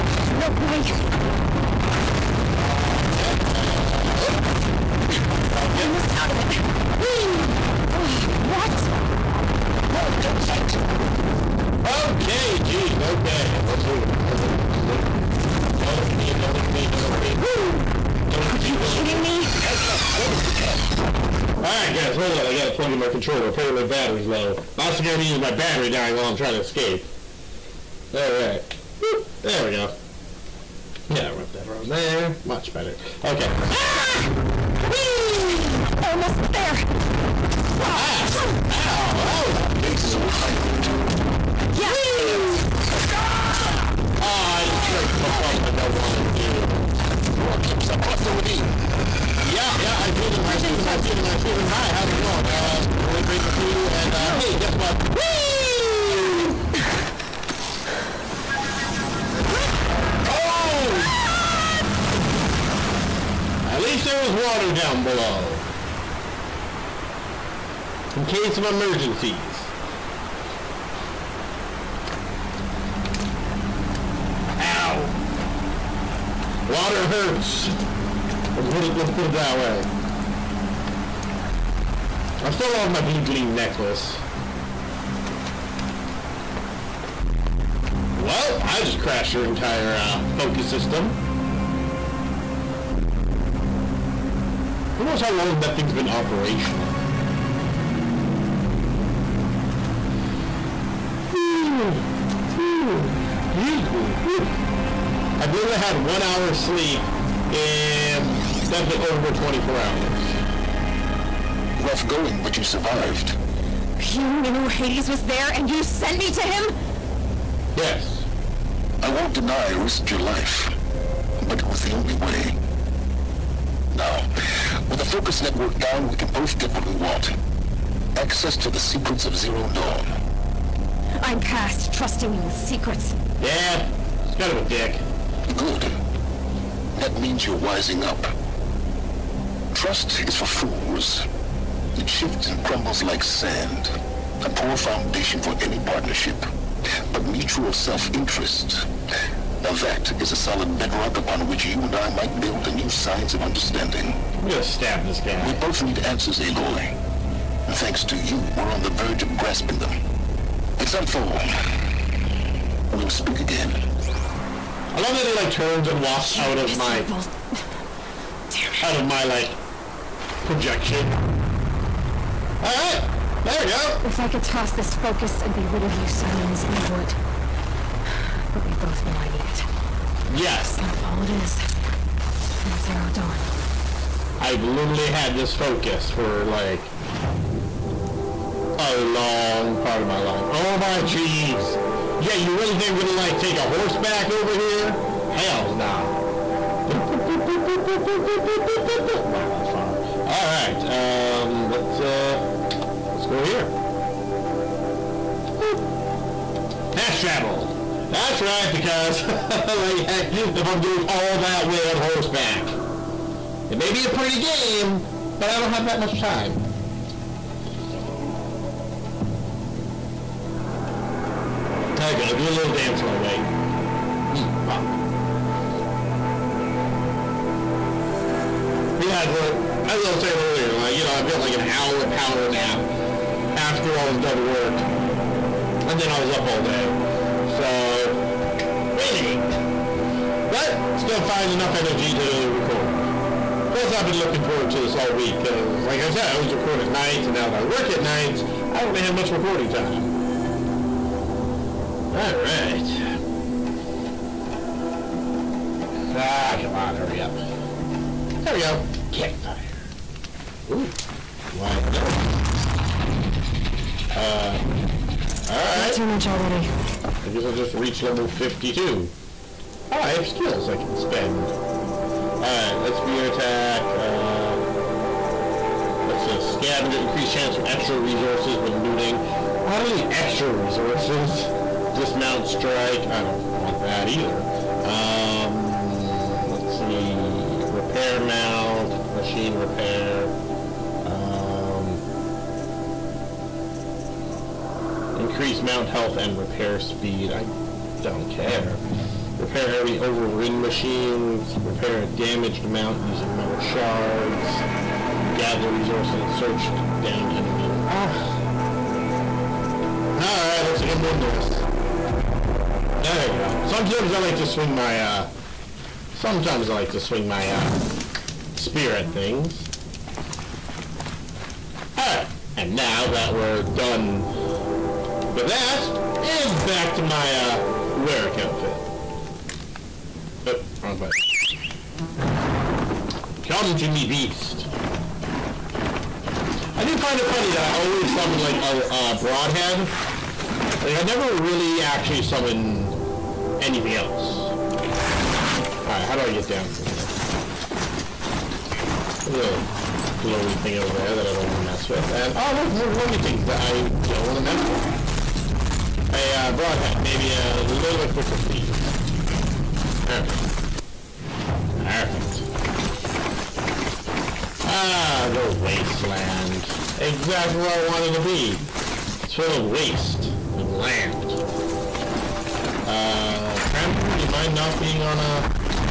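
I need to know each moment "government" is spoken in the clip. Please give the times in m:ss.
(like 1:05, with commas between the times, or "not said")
not said.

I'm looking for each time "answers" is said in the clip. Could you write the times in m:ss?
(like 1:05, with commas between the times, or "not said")
2:36.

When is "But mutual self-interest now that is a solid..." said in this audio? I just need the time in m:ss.
2:27.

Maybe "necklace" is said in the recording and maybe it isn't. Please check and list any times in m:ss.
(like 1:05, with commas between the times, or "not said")
1:23.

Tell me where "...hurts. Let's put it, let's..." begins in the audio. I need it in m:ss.
1:17.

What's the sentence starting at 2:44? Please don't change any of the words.
I love that he like turns and walks out of my out of my like projection.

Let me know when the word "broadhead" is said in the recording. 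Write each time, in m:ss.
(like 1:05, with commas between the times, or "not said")
5:39, 5:56.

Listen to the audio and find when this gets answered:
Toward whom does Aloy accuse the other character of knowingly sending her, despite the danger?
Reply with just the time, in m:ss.
1:54.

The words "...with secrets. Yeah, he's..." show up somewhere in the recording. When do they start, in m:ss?
2:12.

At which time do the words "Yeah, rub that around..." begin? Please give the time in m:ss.
0:31.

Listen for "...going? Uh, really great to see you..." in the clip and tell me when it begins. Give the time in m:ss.
0:52.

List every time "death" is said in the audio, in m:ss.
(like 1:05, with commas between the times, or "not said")
not said.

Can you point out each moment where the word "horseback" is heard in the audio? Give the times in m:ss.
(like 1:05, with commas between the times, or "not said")
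3:13, 3:31.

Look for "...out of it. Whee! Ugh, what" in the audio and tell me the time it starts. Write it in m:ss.
0:06.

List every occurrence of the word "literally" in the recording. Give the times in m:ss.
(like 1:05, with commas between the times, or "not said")
1:45, 3:04.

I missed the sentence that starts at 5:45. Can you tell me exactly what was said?
Alright, how do I get down from here?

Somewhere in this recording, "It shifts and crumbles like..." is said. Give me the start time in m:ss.
2:21.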